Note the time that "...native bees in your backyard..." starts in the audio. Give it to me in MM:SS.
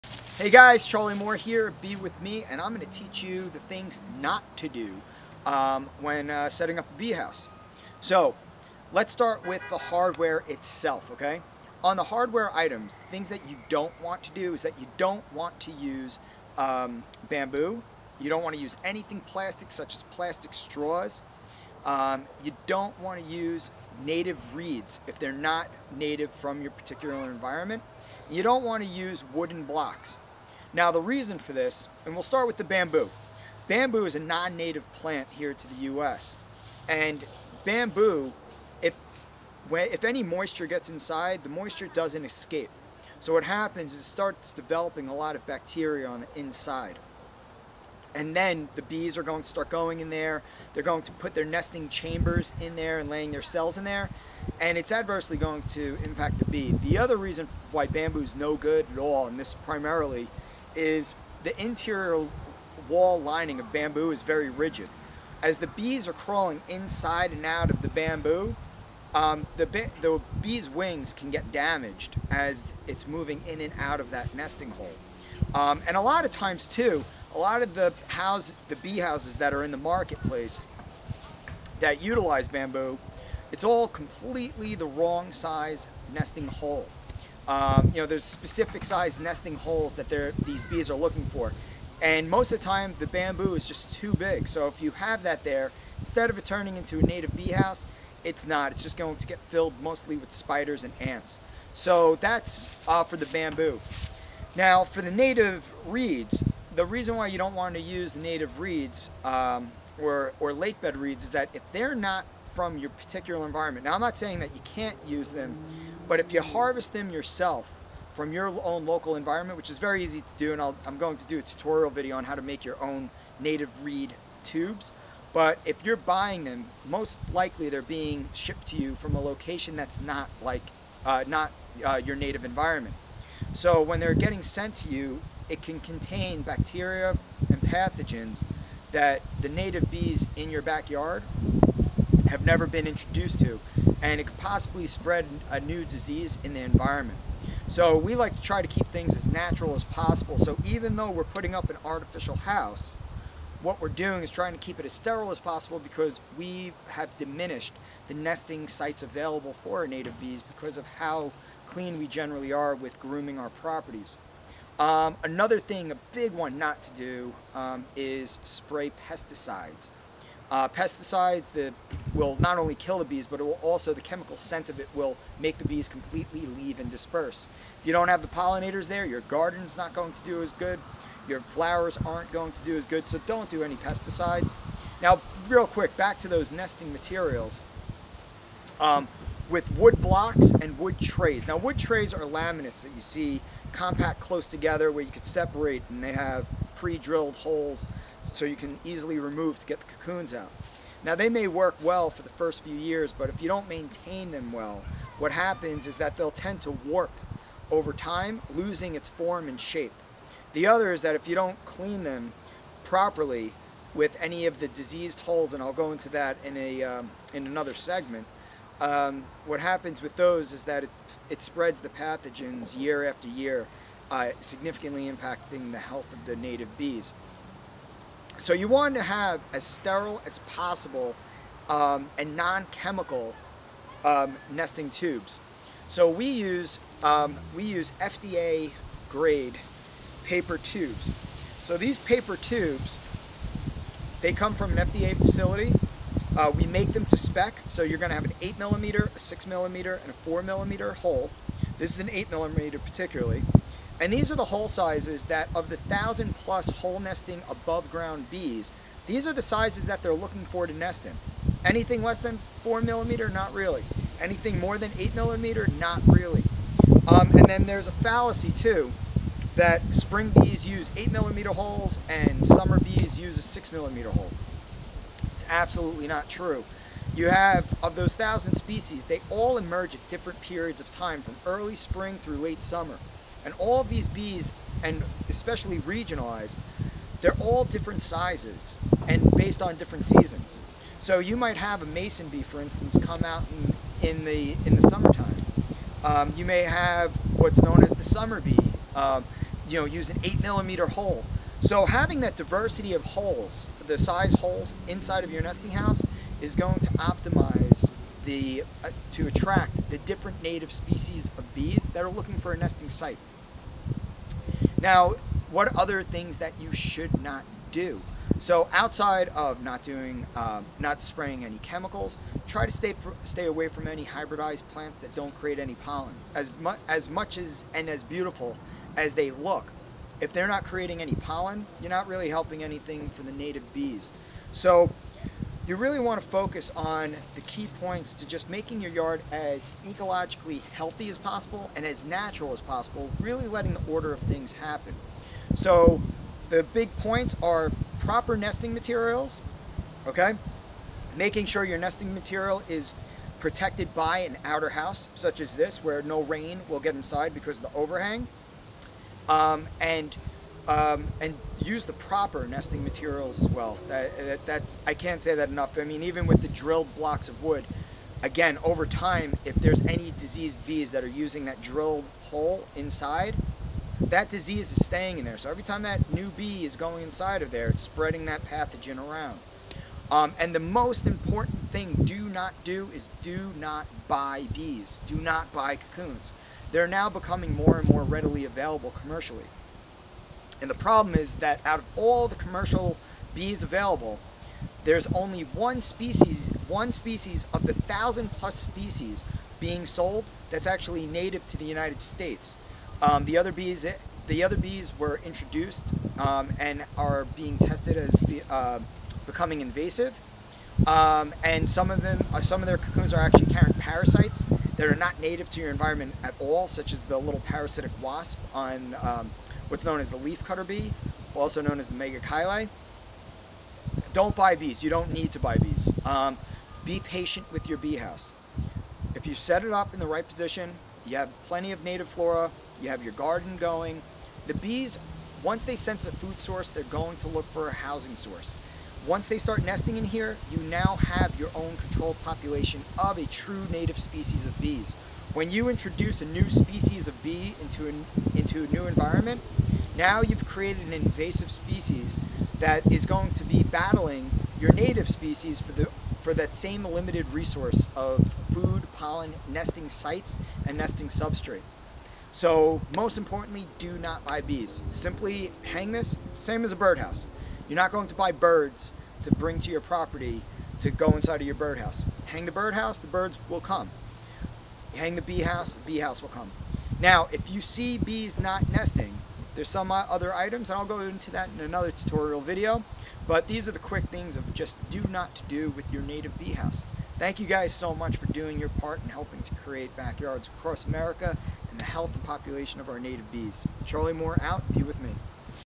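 02:19.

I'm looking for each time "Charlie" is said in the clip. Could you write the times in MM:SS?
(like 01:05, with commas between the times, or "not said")
00:00, 08:13.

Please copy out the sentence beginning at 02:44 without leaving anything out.
Um, another thing, a big one not to do, um, is spray pesticides.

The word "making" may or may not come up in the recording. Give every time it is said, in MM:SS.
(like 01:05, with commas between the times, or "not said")
05:38, 05:51.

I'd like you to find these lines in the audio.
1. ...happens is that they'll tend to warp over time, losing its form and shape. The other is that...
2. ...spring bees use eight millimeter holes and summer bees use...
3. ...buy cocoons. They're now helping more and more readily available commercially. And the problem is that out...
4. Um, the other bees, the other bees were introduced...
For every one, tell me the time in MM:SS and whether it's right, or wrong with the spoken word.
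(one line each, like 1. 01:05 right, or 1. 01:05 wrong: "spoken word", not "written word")
1. 03:25 right
2. 04:29 right
3. 06:25 wrong: "becoming", not "helping"
4. 06:43 right.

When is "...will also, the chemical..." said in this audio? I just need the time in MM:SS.
02:53.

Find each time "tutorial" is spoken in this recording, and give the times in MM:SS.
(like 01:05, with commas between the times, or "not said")
02:01, 08:01.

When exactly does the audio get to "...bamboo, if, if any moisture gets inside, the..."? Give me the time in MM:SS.
00:37.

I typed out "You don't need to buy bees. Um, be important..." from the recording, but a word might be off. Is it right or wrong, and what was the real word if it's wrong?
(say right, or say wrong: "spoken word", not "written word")
wrong: "patient", not "important".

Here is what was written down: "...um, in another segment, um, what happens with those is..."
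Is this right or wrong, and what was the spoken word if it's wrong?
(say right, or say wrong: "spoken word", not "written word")
right.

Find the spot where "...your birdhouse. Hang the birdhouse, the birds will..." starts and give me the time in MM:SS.
07:51.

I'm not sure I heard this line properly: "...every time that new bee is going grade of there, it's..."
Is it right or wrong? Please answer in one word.
wrong.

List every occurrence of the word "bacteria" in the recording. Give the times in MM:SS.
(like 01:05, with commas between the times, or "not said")
00:45, 02:16.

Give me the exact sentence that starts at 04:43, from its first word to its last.
And all of these bees, and especially regionalized, they're all different sizes and based on different seasons.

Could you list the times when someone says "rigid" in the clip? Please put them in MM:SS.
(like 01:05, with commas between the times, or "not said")
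01:04.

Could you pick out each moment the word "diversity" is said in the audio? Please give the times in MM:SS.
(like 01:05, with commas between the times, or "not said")
05:02.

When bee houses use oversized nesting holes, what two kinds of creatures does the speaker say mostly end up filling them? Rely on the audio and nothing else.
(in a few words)
Spiders and ants.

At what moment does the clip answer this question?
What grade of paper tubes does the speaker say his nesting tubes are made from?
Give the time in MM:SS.
03:58.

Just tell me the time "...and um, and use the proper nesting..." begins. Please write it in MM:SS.
05:59.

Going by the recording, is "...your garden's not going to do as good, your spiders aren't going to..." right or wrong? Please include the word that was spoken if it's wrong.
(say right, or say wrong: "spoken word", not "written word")
wrong: "flowers", not "spiders".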